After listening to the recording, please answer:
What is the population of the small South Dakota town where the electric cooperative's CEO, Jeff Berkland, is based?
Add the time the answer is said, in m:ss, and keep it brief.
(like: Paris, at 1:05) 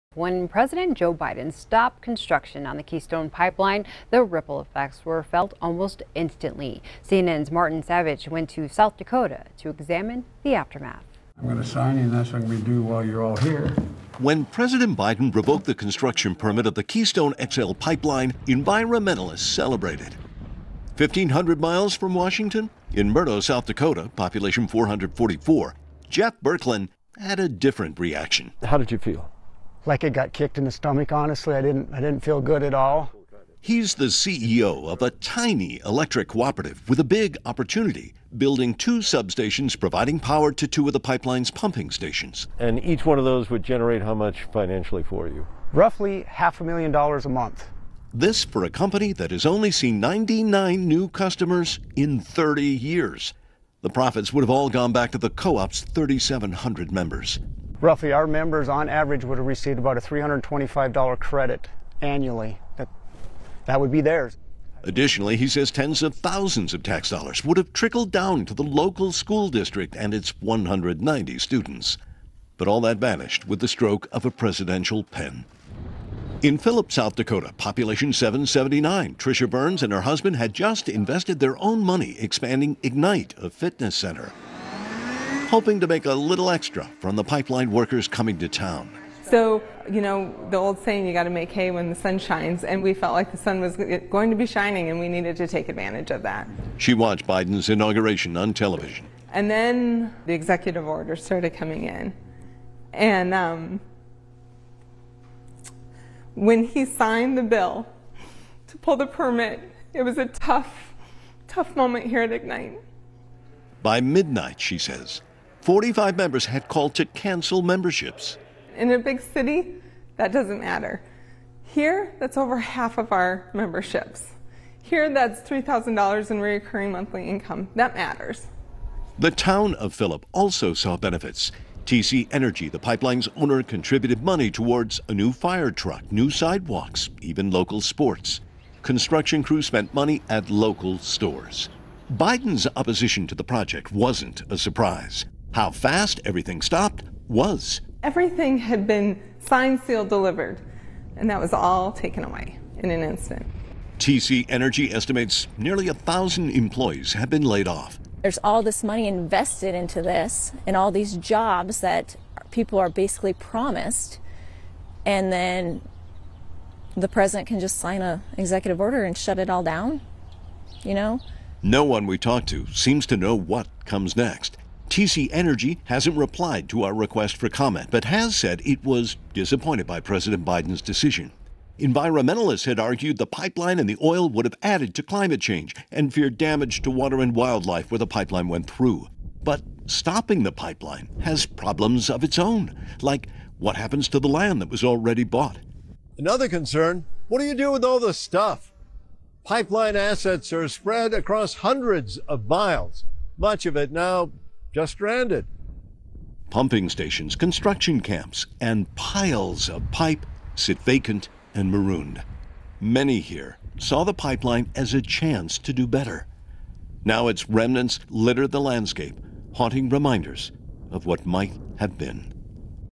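444, at 0:24.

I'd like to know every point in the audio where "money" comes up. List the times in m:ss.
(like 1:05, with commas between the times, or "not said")
1:21, 2:14, 2:19, 2:38.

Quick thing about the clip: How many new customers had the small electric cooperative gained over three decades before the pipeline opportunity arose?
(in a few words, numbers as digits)
99.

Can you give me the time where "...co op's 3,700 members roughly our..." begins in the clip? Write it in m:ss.
0:55.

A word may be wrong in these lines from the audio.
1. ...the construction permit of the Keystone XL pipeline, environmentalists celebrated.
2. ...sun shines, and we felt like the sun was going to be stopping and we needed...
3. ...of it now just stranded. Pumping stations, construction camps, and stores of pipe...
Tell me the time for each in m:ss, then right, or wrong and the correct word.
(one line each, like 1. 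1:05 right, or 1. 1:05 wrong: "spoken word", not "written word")
1. 0:15 right
2. 1:31 wrong: "shining", not "stopping"
3. 3:23 wrong: "piles", not "stores".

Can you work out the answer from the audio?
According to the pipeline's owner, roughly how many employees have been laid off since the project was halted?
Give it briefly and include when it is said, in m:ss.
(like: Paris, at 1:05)
nearly 1,000, at 2:35.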